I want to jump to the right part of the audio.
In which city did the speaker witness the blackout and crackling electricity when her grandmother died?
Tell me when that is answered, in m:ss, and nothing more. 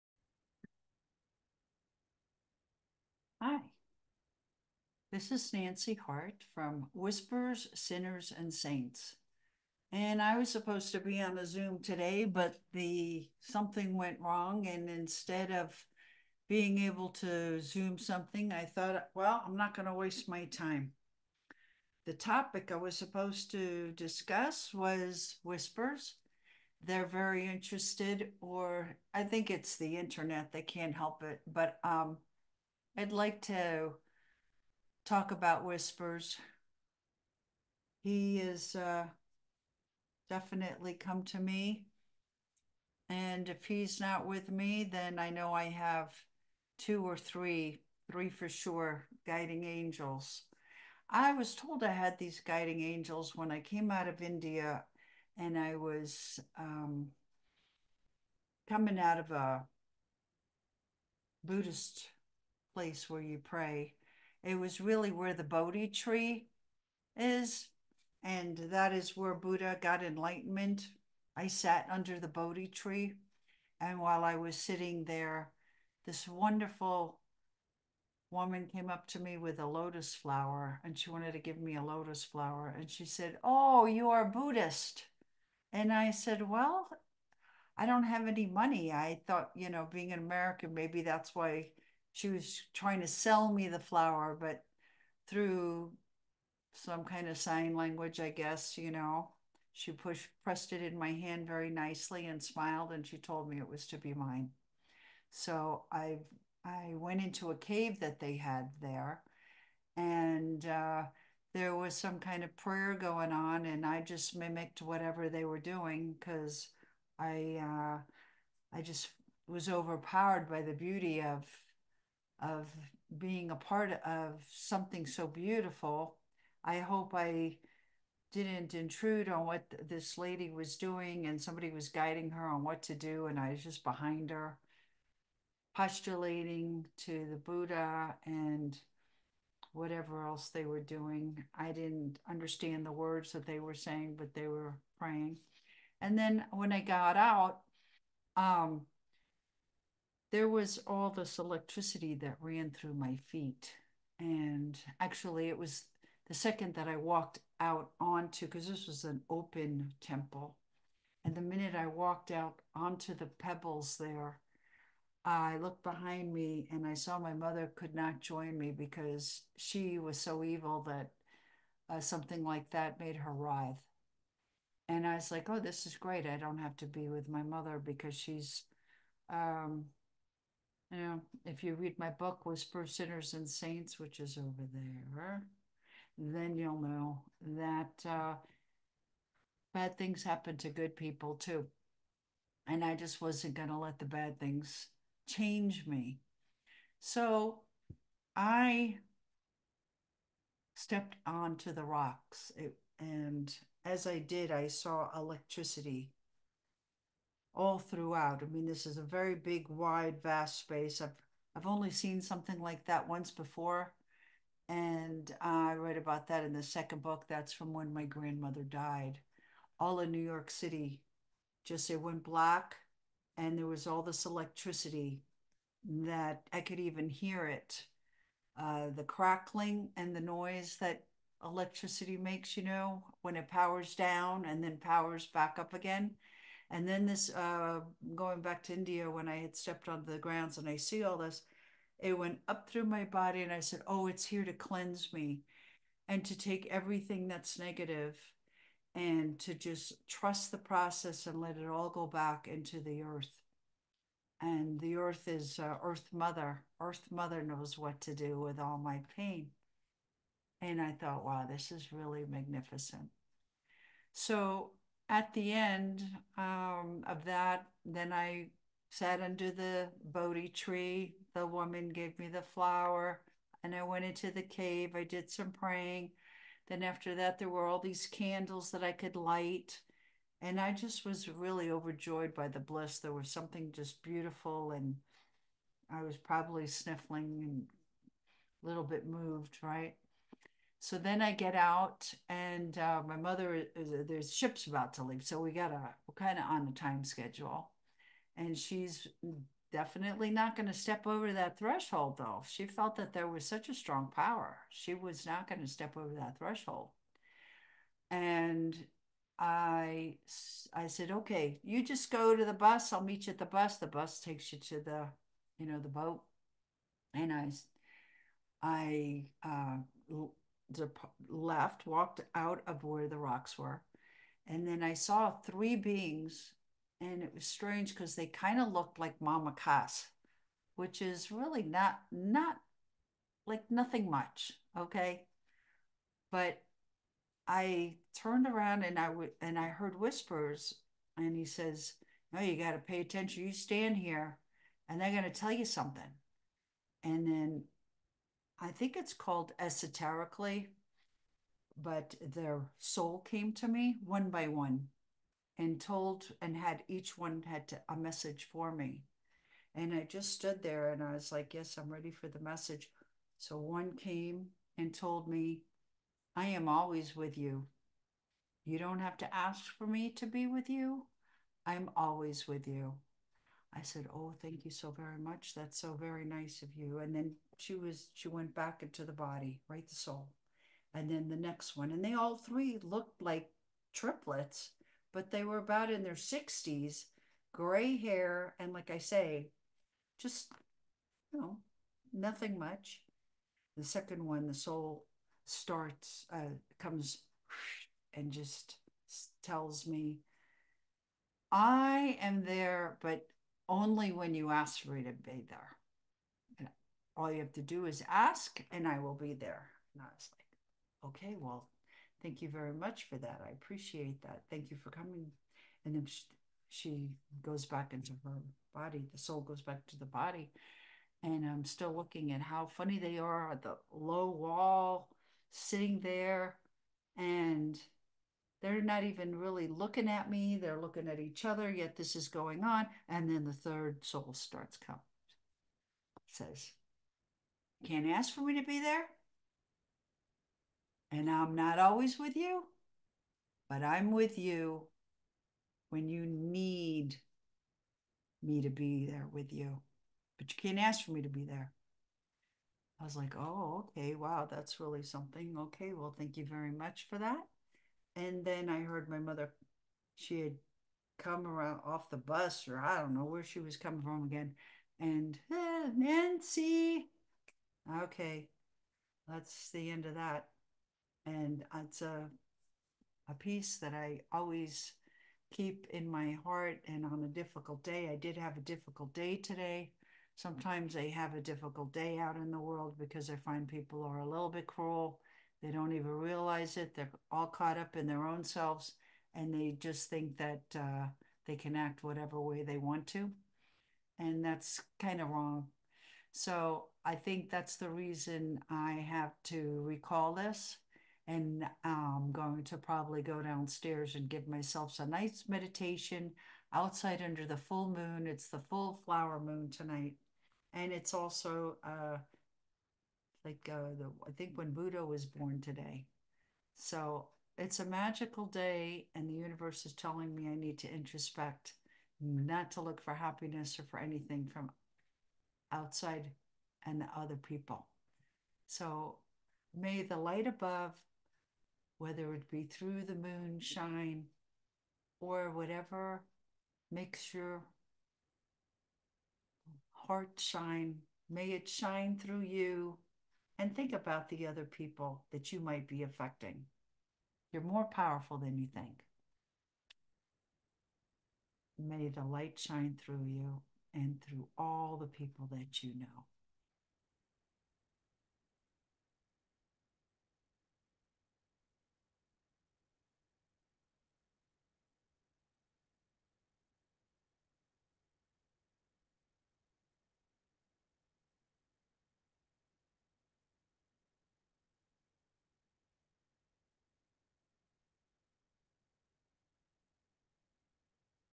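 3:40.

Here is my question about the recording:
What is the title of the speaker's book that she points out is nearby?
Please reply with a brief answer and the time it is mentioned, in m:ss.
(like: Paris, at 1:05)
Whisper Sinners and Saints, at 3:02.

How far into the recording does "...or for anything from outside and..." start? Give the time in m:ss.
8:43.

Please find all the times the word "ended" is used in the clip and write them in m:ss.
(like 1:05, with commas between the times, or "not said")
not said.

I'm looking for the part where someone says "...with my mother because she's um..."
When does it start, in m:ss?
2:57.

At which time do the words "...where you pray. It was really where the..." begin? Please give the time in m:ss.
1:03.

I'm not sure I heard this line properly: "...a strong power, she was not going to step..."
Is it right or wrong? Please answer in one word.
right.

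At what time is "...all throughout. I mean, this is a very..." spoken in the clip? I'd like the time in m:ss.
3:27.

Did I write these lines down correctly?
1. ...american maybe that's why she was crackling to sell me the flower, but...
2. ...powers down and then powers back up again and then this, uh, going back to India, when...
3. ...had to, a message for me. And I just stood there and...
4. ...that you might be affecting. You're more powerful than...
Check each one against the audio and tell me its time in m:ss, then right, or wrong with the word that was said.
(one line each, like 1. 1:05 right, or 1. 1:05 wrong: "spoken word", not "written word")
1. 1:30 wrong: "trying", not "crackling"
2. 3:53 right
3. 5:57 right
4. 9:05 right.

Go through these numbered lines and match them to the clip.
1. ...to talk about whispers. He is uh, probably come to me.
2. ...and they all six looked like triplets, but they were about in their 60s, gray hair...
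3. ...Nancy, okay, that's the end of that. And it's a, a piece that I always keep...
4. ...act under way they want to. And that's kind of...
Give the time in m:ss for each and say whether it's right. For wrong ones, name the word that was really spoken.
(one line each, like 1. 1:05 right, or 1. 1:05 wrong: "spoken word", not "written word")
1. 0:33 wrong: "definitely", not "probably"
2. 6:21 wrong: "three", not "six"
3. 7:45 right
4. 8:11 wrong: "whatever", not "under".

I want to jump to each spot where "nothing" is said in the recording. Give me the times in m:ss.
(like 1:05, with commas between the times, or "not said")
5:33, 6:32.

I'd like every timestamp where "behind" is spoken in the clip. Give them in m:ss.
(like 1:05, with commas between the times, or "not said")
2:13, 2:45.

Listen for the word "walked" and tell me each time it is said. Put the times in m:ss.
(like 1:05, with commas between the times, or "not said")
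2:36, 2:41, 5:21.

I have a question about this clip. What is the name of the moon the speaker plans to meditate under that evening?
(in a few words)
Full flower moon.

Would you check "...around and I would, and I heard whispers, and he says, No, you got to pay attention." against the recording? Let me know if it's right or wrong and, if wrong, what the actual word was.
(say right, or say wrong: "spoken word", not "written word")
right.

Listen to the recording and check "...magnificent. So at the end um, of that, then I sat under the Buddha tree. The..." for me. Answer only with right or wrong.
wrong.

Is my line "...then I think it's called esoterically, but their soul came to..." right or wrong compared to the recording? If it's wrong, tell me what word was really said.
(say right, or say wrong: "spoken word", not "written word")
right.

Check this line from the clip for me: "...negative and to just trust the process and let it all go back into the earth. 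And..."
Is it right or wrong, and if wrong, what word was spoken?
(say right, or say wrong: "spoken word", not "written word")
right.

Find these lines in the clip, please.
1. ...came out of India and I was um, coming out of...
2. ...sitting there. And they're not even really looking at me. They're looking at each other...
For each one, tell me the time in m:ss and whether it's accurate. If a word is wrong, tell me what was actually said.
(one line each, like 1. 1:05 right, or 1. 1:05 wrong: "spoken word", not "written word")
1. 0:53 right
2. 7:05 right.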